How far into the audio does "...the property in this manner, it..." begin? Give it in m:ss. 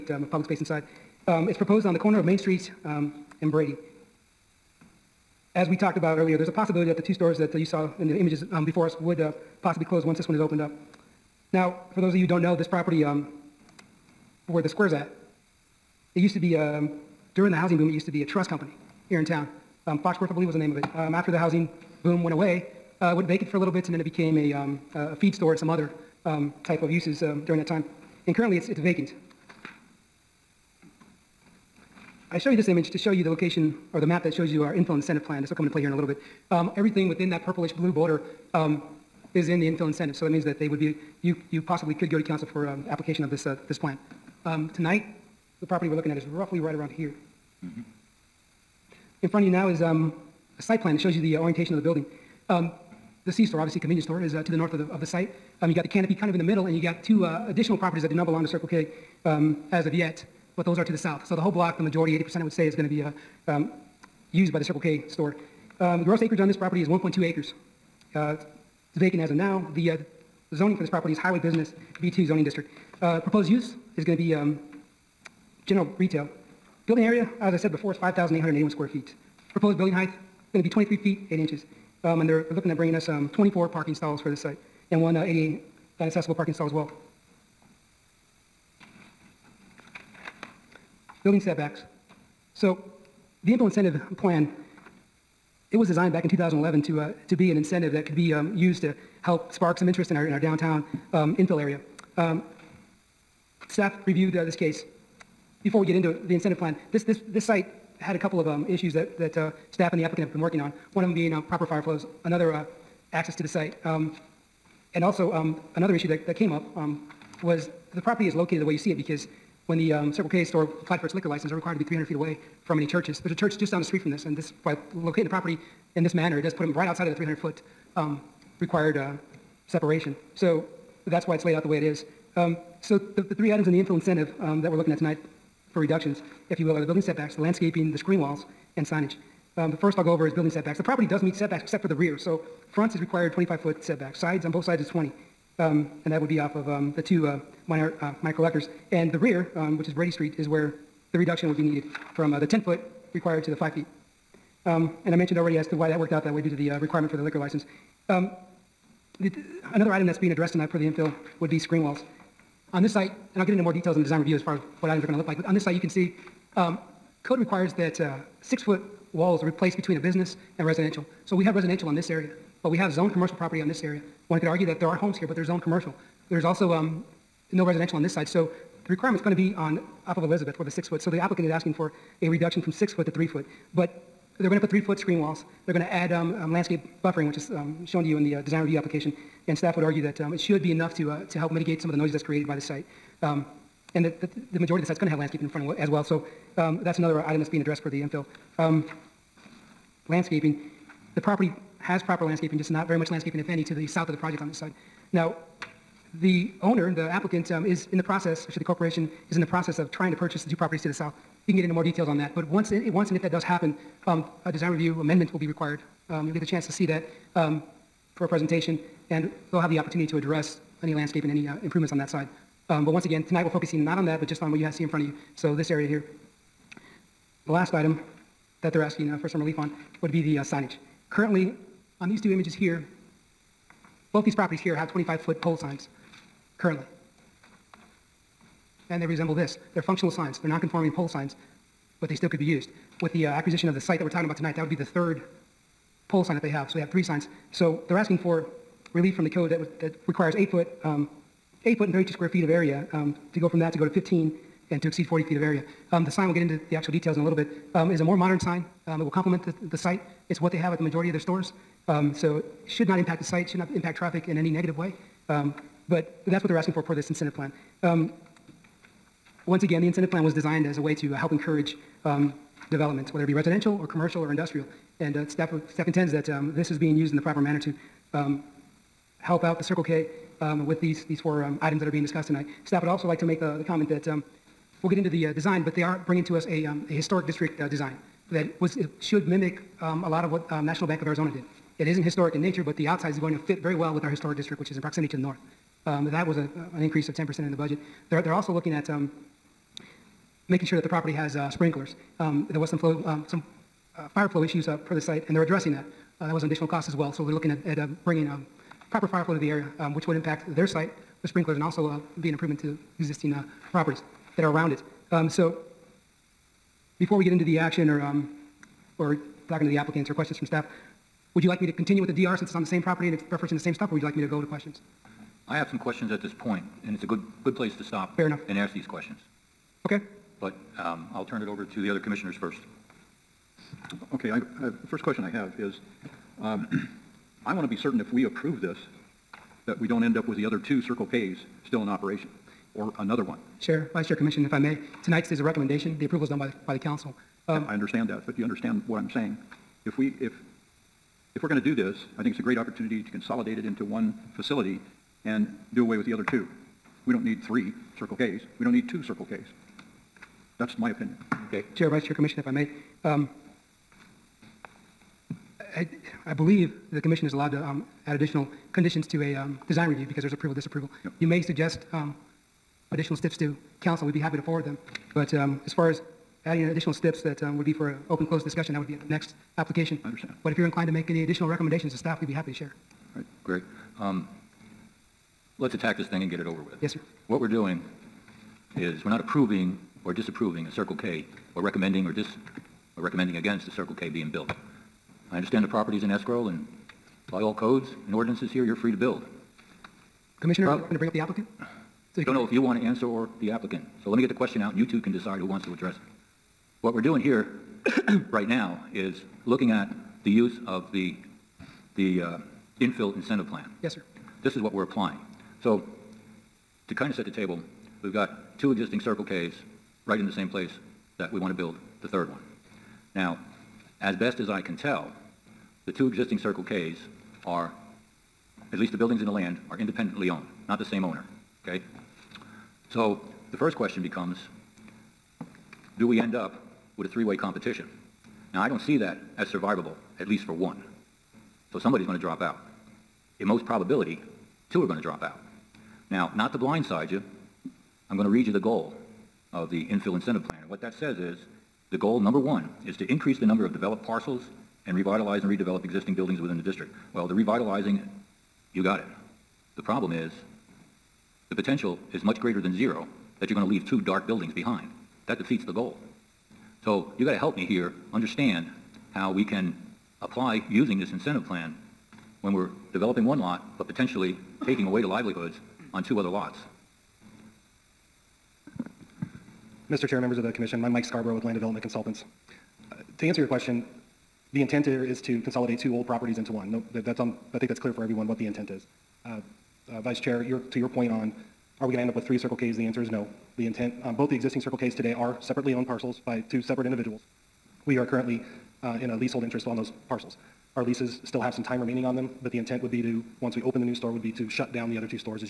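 2:05.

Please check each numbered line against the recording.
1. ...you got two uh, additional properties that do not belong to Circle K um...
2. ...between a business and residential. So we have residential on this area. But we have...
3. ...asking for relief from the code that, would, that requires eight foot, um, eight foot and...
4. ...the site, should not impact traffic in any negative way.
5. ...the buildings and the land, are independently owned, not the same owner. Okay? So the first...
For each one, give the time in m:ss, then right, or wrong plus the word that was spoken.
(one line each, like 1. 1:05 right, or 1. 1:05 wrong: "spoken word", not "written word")
1. 0:56 right
2. 2:49 right
3. 4:07 right
4. 4:23 right
5. 7:08 right.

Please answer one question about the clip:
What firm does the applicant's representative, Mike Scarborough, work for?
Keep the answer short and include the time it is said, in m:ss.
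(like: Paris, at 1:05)
Land Development Consultants, at 8:01.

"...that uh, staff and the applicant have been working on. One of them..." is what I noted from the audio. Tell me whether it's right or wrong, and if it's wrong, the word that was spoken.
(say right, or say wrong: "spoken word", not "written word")
right.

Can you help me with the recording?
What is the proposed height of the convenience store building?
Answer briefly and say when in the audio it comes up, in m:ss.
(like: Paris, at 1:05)
23 feet, 8 inches, at 1:20.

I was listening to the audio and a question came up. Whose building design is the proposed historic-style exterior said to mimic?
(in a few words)
National Bank of Arizona.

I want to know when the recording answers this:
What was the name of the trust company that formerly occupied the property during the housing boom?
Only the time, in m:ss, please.
0:20.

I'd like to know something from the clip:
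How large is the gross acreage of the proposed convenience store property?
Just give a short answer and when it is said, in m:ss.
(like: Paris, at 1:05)
1.2 acres, at 1:06.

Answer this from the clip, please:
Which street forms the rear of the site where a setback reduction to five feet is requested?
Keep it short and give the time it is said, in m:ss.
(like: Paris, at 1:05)
Brady Street, at 2:29.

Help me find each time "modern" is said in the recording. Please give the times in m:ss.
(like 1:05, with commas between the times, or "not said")
4:18.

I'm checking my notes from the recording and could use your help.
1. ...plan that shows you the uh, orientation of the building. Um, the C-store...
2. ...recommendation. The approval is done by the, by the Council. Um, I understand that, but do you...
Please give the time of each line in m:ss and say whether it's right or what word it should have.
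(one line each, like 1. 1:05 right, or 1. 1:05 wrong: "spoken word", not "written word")
1. 0:50 right
2. 5:45 right.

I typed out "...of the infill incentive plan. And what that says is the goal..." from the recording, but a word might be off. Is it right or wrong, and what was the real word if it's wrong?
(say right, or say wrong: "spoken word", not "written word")
right.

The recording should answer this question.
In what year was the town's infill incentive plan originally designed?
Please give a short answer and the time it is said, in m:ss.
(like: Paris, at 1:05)
2011, at 1:36.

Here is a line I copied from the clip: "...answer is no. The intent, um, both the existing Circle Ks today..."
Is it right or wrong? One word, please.
right.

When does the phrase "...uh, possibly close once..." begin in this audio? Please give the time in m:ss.
0:09.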